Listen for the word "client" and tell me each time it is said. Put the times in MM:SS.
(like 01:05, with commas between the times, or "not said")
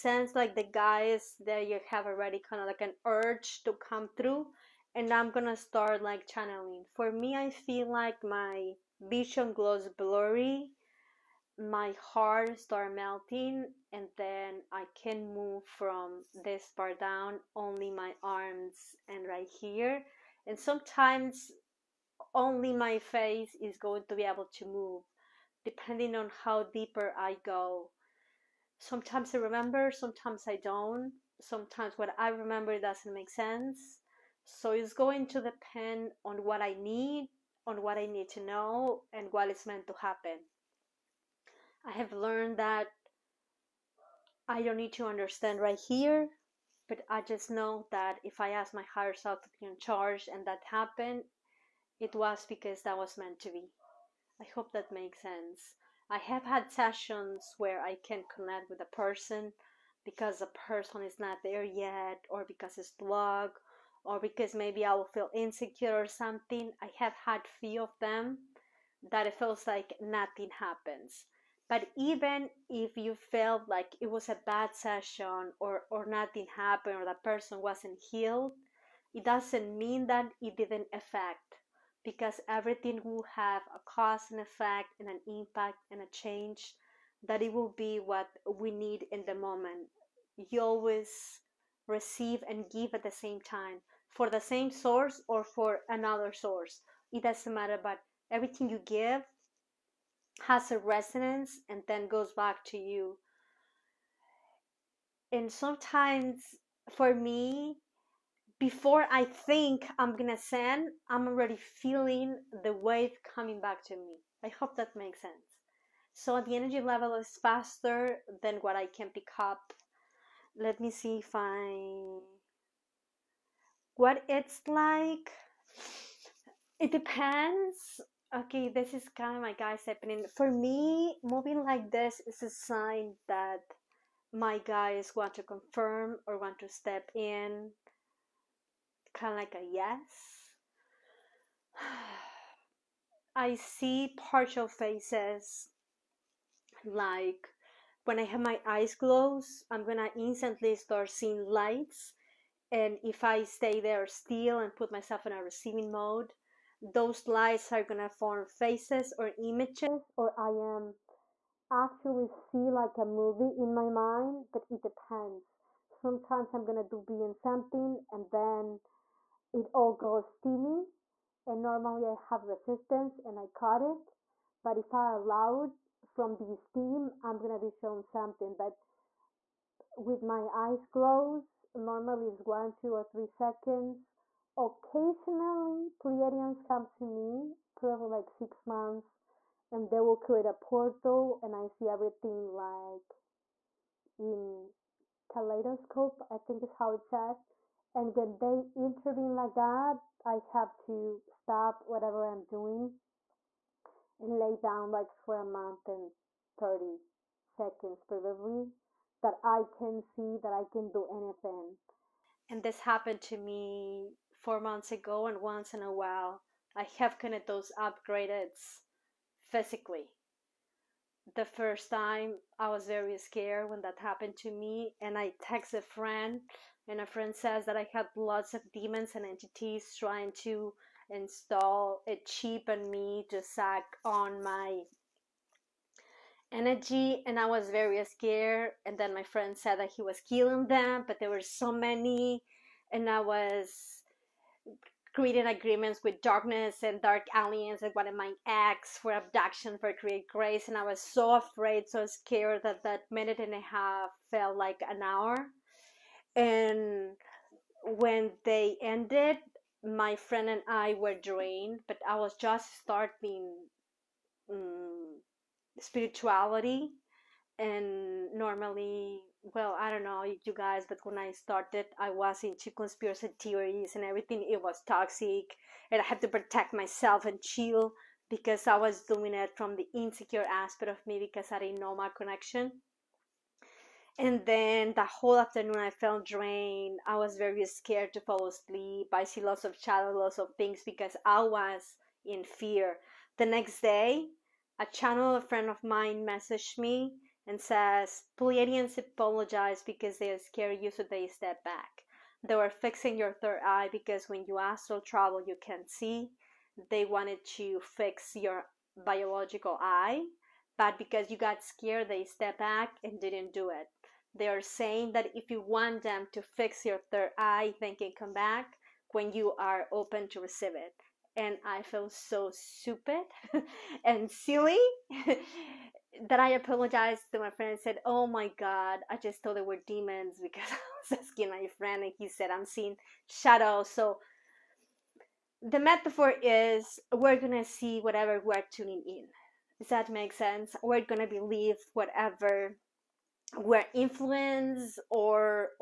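not said.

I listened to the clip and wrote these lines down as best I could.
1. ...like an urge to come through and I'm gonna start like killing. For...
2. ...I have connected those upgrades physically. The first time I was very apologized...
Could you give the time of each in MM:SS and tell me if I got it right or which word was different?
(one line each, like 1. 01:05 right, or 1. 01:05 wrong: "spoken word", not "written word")
1. 00:02 wrong: "channeling", not "killing"
2. 03:36 wrong: "scared", not "apologized".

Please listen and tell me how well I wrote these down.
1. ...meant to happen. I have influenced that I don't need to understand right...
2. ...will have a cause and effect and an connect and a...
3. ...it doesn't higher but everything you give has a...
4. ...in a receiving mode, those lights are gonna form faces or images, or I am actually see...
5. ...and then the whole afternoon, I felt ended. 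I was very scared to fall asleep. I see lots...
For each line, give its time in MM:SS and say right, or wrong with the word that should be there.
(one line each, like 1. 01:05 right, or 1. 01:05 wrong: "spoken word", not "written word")
1. 00:39 wrong: "learned", not "influenced"
2. 01:23 wrong: "impact", not "connect"
3. 01:37 wrong: "matter", not "higher"
4. 02:35 right
5. 04:44 wrong: "drained", not "ended".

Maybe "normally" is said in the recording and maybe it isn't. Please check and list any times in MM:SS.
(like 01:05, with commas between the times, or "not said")
02:51, 03:01, 04:28.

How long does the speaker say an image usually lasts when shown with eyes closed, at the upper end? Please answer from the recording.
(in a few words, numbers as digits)
3 seconds.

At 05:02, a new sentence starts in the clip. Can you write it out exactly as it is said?
They were fixing your third eye because when you astral travel, you can see.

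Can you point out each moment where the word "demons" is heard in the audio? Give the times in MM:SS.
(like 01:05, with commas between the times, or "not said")
03:48, 05:29.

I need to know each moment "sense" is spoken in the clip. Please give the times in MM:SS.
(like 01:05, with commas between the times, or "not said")
00:33, 00:55, 01:55, 05:40.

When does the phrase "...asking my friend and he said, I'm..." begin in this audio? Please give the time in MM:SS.
05:31.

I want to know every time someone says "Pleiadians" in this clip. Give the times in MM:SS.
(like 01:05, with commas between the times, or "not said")
03:06, 04:58.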